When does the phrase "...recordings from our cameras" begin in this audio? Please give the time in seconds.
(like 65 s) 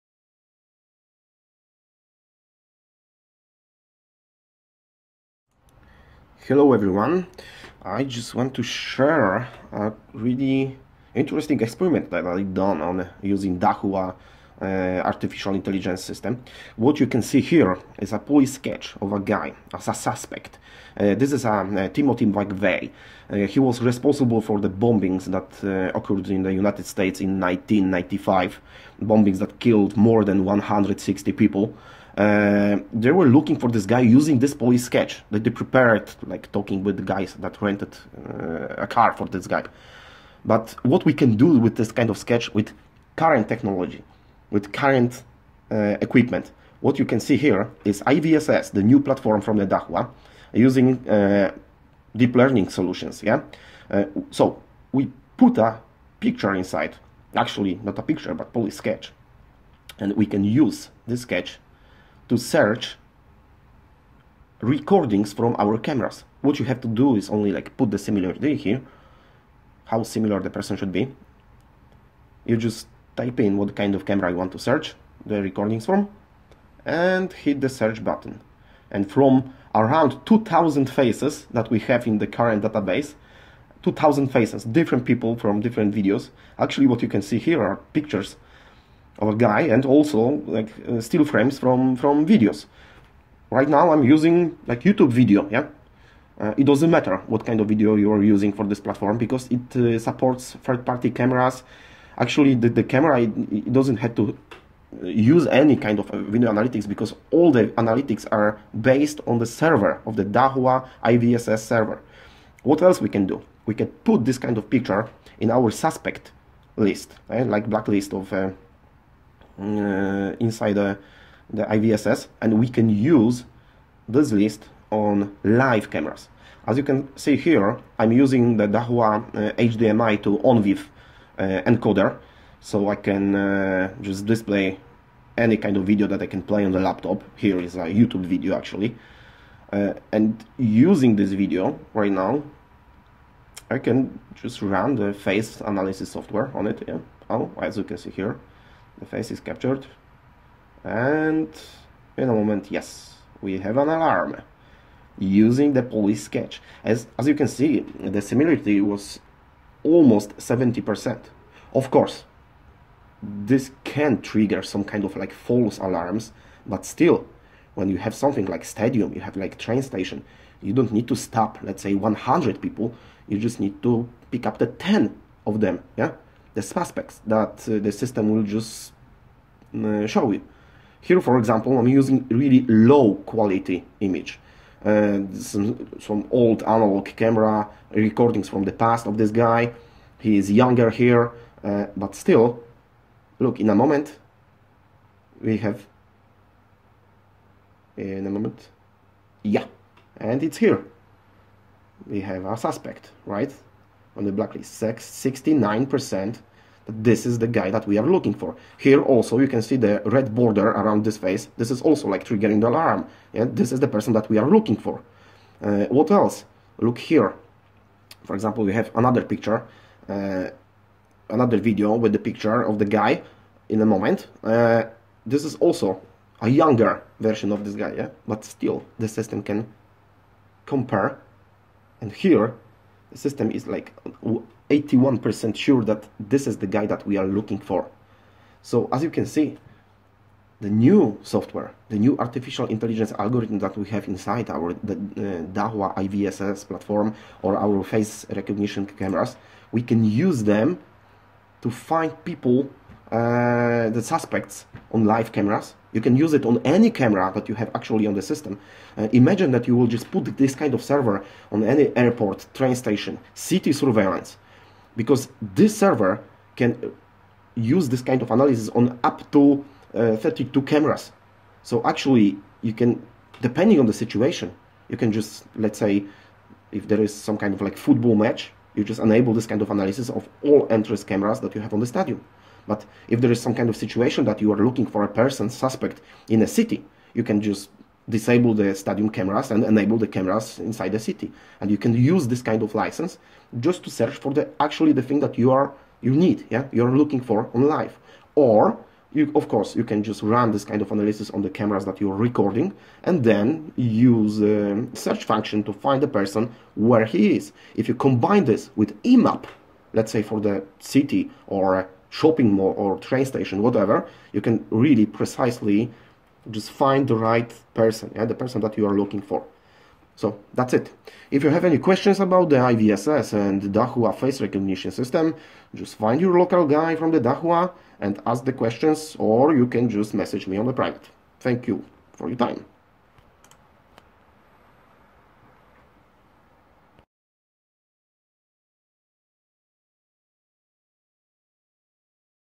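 64 s.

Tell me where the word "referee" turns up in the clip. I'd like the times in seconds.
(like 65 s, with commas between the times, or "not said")
not said.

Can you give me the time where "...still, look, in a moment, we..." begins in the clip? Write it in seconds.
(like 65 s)
192 s.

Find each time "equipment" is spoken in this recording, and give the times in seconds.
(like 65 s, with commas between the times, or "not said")
46 s.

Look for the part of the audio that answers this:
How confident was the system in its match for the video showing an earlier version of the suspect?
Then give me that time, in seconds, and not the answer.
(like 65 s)
234 s.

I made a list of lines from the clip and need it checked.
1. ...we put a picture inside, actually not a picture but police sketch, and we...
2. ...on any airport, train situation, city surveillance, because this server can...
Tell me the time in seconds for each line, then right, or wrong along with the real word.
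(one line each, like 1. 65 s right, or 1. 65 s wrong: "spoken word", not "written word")
1. 54 s right
2. 261 s wrong: "station", not "situation".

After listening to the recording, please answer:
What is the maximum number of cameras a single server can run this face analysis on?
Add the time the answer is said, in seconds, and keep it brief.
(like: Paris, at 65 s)
32, at 270 s.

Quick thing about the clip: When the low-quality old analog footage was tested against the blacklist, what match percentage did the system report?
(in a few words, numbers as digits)
69%.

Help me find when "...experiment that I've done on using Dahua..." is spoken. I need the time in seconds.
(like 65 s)
11 s.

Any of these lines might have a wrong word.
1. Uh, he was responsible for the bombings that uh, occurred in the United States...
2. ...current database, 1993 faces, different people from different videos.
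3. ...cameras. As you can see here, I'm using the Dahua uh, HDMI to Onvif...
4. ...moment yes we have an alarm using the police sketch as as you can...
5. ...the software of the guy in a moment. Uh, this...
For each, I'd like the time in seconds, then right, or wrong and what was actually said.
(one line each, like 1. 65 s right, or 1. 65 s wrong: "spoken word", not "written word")
1. 23 s right
2. 82 s wrong: "2000", not "1993"
3. 125 s right
4. 152 s right
5. 222 s wrong: "picture", not "software".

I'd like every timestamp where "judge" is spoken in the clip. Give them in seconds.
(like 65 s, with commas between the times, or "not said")
not said.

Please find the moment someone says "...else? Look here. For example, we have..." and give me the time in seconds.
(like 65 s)
216 s.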